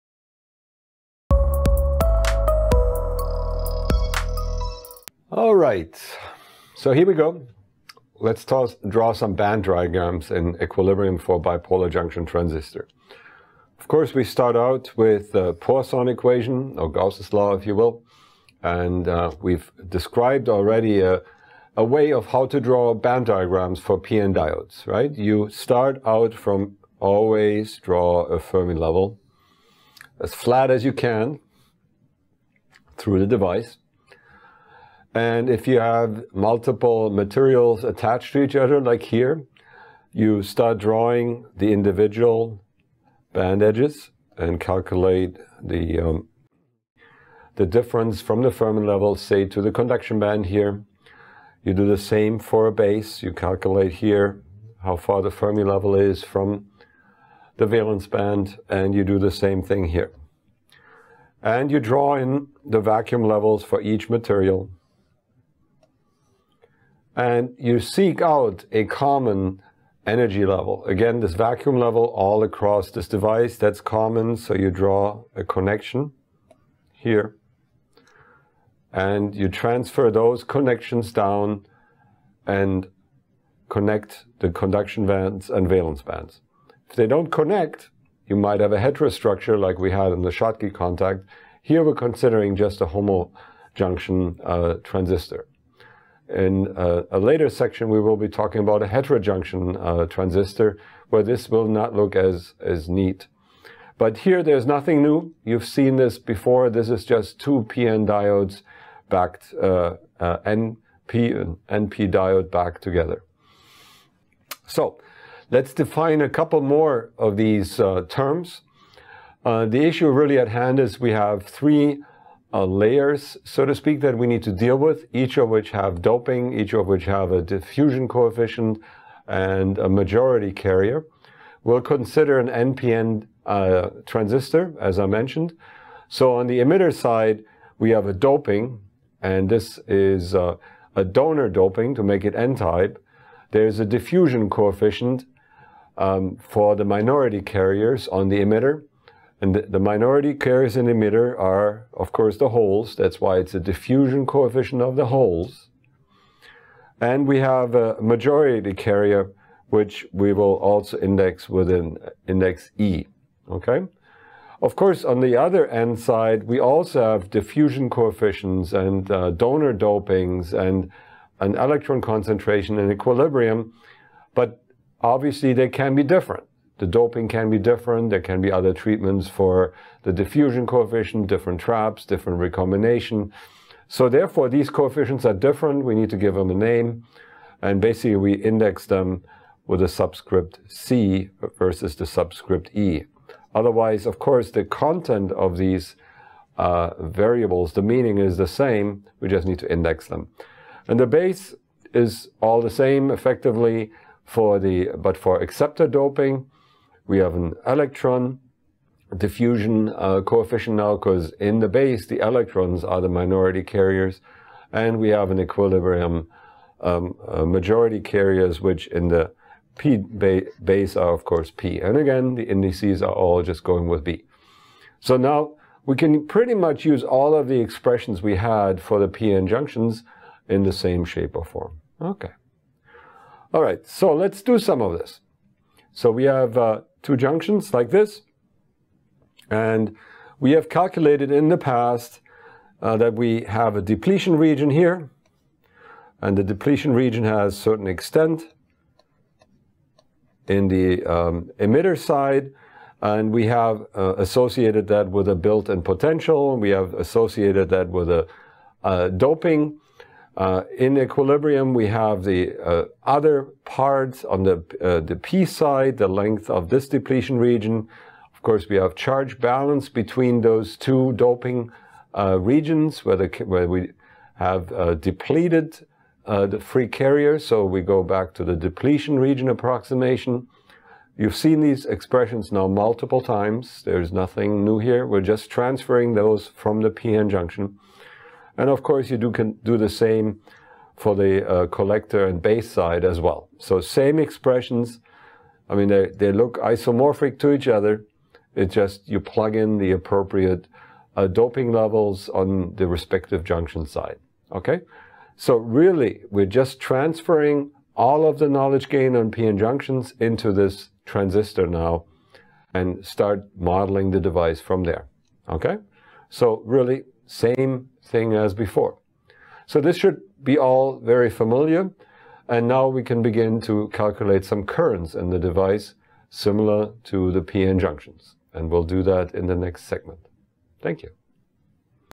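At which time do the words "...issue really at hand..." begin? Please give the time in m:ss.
1:59.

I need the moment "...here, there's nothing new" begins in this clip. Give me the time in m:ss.
1:44.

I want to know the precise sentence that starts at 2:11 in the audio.
We'll consider an NPN uh, transistor, as I mentioned.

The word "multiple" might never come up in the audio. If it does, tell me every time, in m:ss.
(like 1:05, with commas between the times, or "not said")
0:36, 4:42.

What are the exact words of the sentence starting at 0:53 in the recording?
You calculate here how far the Fermi level is from the valence band, and you do the same thing here.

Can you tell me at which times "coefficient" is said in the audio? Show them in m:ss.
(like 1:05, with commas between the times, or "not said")
2:08, 2:24, 2:34, 2:47, 3:00, 3:04, 3:30.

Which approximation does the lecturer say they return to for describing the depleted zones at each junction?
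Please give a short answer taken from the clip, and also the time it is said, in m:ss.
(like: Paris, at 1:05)
depletion region approximation, at 4:38.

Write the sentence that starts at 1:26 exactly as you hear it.
If they don't connect, you might have a heterostructure like we had in the Schottky contact.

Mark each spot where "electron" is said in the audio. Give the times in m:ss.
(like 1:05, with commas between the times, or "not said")
2:51, 3:27, 3:32.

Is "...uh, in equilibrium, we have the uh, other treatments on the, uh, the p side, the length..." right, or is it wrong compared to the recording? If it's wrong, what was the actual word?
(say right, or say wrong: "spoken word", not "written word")
wrong: "parts", not "treatments".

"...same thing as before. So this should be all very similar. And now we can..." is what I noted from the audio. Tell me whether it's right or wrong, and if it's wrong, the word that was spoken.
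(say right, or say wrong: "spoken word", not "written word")
wrong: "familiar", not "similar".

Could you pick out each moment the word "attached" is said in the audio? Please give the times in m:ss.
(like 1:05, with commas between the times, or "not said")
0:37.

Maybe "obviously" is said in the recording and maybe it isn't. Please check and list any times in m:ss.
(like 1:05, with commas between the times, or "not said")
2:55.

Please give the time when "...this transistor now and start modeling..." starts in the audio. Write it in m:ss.
5:10.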